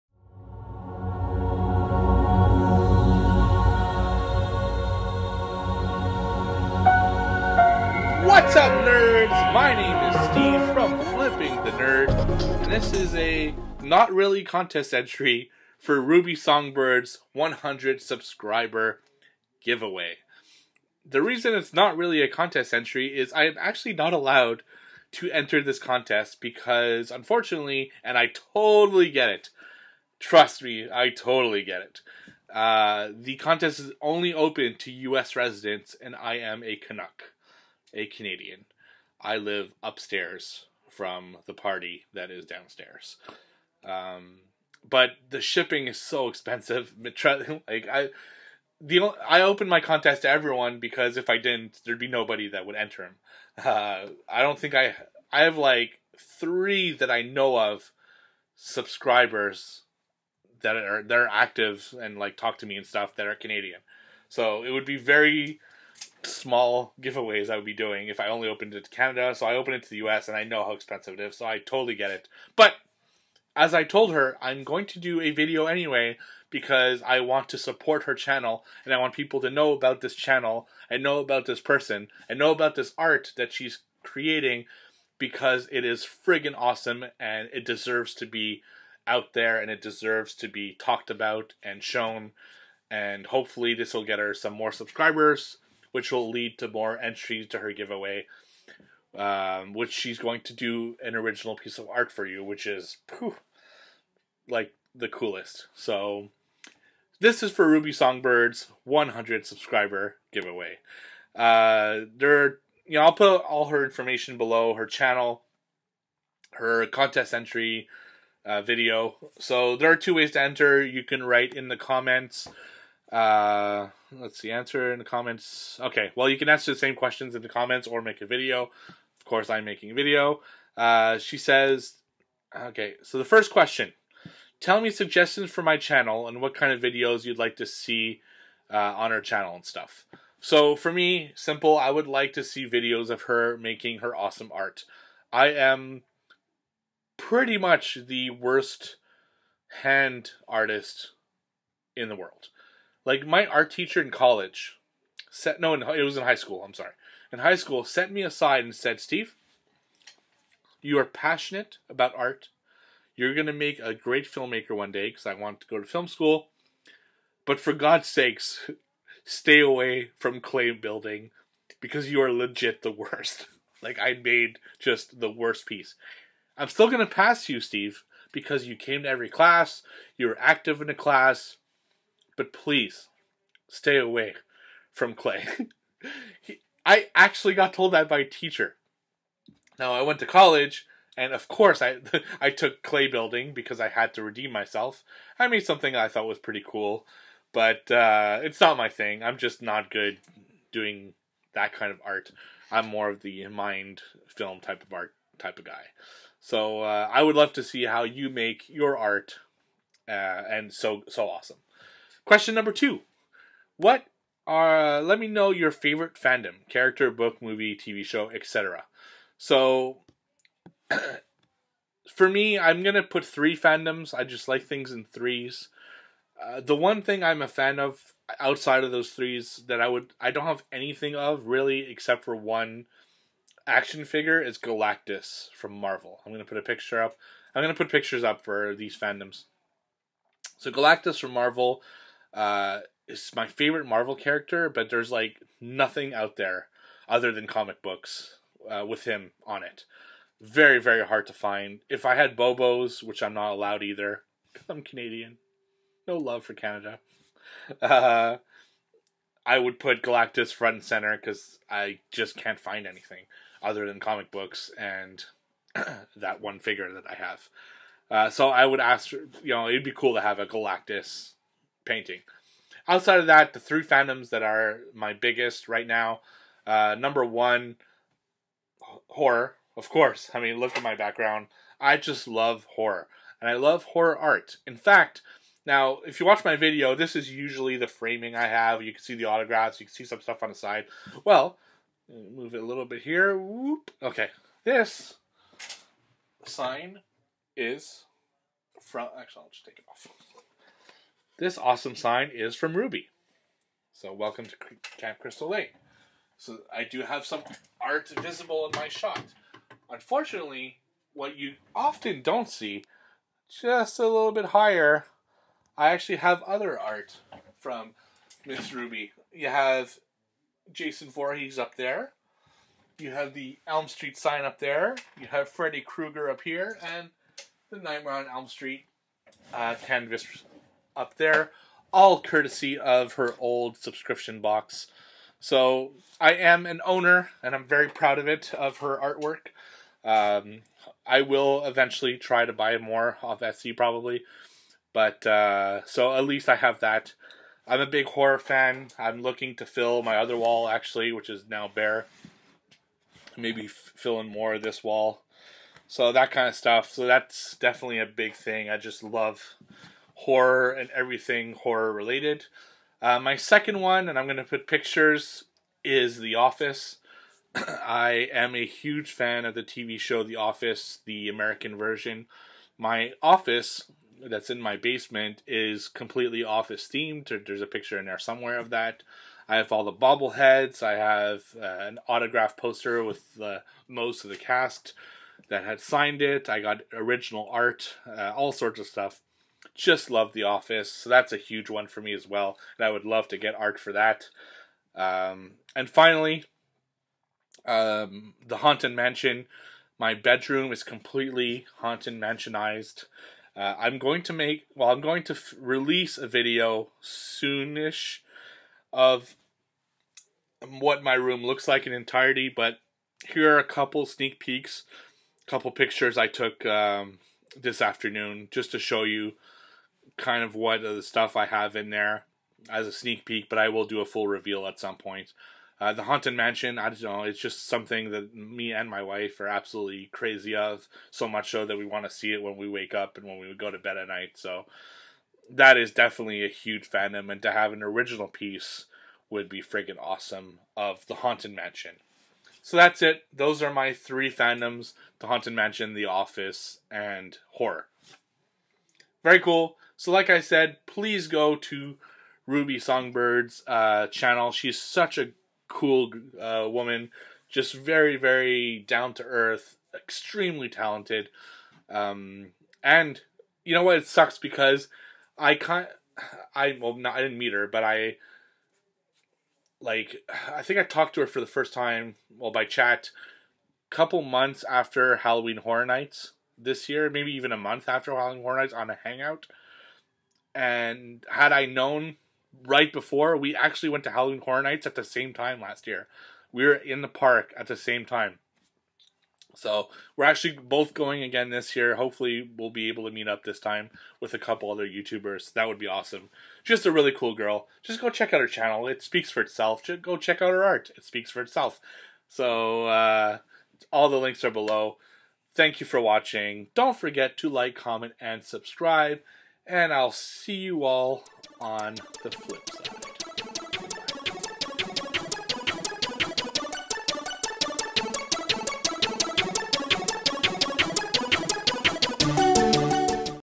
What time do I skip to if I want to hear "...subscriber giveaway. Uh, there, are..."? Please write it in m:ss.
1:49.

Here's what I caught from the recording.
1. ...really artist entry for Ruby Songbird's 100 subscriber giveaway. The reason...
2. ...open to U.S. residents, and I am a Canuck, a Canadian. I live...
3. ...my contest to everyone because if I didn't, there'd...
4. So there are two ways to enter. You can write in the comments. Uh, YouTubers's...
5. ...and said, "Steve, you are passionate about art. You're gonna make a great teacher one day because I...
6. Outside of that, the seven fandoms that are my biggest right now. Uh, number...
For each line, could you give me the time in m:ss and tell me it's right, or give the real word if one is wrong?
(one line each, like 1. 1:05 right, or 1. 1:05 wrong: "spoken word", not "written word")
1. 0:14 wrong: "contest", not "artist"
2. 0:34 right
3. 0:49 right
4. 1:59 wrong: "Let", not "YouTubers"
5. 2:38 wrong: "filmmaker", not "teacher"
6. 4:32 wrong: "three", not "seven".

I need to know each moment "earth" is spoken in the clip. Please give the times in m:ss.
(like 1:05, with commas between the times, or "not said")
7:39.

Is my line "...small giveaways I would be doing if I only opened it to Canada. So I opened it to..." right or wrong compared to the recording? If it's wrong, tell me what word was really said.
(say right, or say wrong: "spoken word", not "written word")
right.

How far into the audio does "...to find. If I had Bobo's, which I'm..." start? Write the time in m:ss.
4:11.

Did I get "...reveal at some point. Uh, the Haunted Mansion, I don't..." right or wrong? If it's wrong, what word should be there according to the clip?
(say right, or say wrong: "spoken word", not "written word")
right.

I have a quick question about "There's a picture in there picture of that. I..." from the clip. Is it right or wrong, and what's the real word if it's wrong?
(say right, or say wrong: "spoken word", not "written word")
wrong: "somewhere", not "picture".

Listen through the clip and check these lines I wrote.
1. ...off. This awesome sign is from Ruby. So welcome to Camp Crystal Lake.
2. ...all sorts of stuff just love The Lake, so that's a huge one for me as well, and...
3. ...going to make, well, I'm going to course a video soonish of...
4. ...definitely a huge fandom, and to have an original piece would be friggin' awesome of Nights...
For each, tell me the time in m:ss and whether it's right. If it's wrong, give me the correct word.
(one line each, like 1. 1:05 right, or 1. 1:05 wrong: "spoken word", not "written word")
1. 4:59 right
2. 6:28 wrong: "Office", not "Lake"
3. 6:43 wrong: "release", not "course"
4. 7:15 wrong: "The", not "Nights".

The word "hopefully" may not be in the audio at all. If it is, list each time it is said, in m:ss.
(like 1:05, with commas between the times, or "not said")
1:33, 8:11.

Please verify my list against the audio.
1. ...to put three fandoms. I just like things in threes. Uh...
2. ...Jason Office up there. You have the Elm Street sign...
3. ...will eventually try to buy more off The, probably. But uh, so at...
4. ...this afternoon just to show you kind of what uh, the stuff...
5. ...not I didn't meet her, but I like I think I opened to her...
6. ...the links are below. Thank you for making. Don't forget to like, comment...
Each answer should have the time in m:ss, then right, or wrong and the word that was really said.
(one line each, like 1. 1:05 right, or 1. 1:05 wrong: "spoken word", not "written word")
1. 3:42 right
2. 5:20 wrong: "Voorhees", not "Office"
3. 5:41 wrong: "Etsy", not "The"
4. 6:57 right
5. 7:46 wrong: "talked", not "opened"
6. 8:24 wrong: "watching", not "making".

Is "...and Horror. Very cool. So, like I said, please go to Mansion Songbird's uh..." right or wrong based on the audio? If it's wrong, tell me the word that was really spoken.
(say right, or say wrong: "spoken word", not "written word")
wrong: "Ruby", not "Mansion".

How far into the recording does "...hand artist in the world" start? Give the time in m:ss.
2:29.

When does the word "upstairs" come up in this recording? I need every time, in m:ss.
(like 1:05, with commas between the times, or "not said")
0:39.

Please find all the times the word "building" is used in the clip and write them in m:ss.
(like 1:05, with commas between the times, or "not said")
2:50, 3:13.